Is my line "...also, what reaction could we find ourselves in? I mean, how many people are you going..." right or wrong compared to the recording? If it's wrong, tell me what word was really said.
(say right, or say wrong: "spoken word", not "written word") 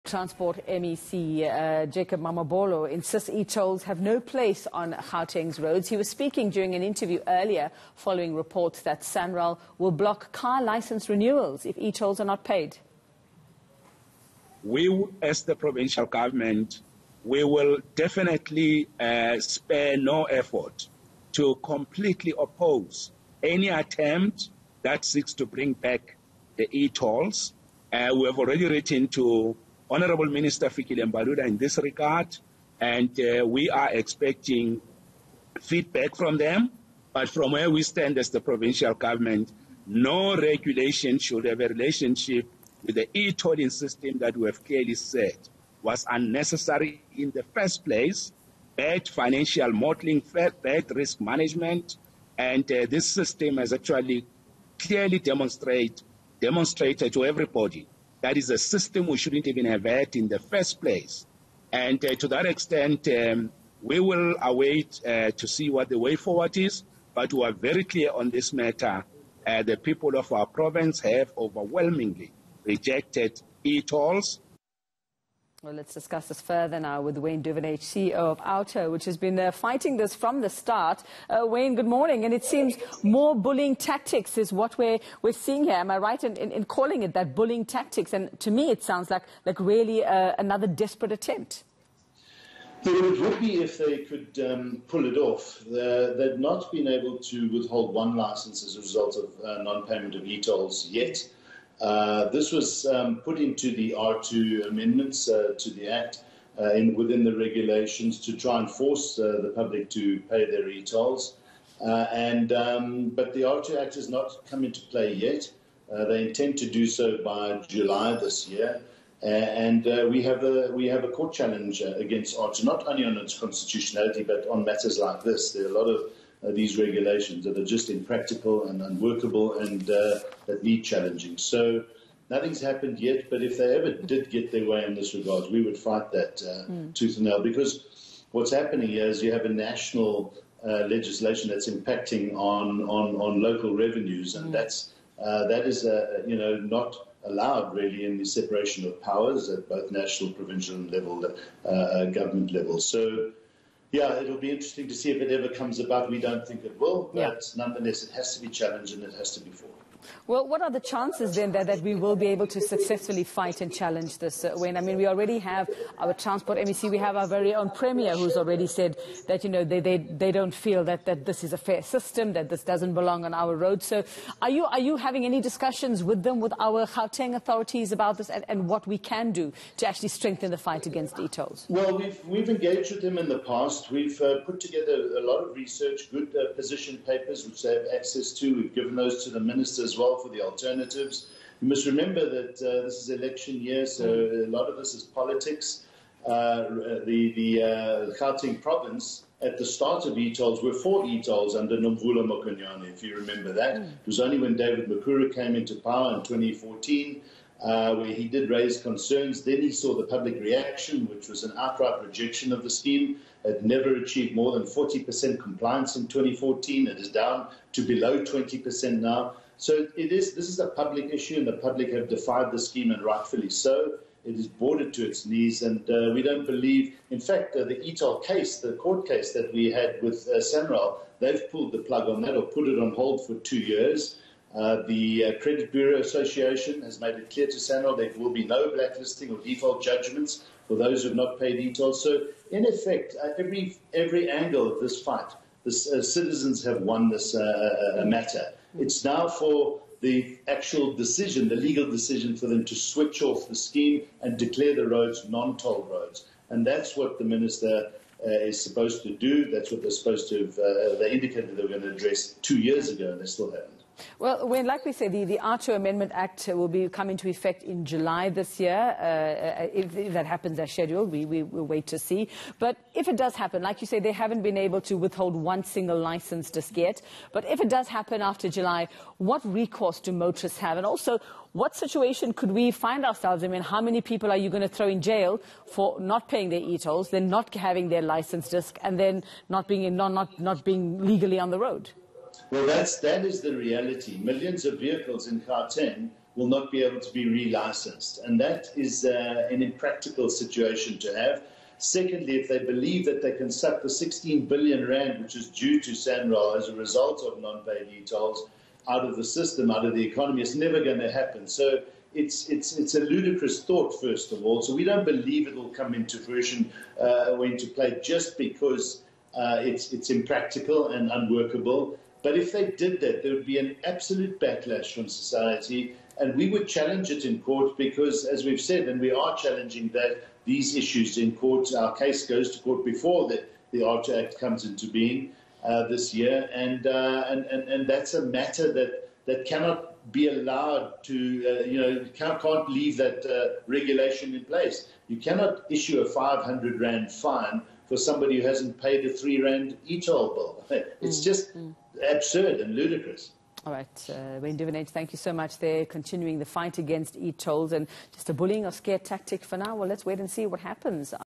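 wrong: "situation", not "reaction".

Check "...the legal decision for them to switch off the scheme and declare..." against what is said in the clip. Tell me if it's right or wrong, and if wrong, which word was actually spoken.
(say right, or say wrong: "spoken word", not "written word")
right.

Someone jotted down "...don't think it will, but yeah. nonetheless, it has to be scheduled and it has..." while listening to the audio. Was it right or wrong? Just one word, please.
wrong.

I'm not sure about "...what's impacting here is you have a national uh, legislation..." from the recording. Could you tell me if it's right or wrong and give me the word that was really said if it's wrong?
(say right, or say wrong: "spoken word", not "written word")
wrong: "happening", not "impacting".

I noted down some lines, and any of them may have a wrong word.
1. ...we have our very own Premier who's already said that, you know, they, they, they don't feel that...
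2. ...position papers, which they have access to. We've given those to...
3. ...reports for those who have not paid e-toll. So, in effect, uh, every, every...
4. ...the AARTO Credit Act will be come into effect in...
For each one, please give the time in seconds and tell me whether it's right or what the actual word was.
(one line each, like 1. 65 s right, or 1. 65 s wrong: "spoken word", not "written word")
1. 166 s right
2. 186 s right
3. 239 s wrong: "judgments", not "reports"
4. 265 s wrong: "Amendment", not "Credit".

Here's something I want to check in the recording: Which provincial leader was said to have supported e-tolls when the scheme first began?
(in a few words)
Nomvula Mokonyane.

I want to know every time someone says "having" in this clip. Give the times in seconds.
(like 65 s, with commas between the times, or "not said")
174 s, 287 s.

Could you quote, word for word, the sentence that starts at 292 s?
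Well, that's, that is the reality.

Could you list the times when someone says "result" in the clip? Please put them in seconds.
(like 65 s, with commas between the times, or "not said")
98 s, 306 s.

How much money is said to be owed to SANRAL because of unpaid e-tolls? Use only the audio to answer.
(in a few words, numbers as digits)
16 billion rand.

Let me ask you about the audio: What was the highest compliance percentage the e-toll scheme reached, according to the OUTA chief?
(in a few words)
40%.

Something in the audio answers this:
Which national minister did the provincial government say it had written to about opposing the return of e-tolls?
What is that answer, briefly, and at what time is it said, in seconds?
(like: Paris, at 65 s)
Fikile Mbalula, at 30 s.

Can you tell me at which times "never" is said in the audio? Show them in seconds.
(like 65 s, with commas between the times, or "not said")
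213 s, 310 s.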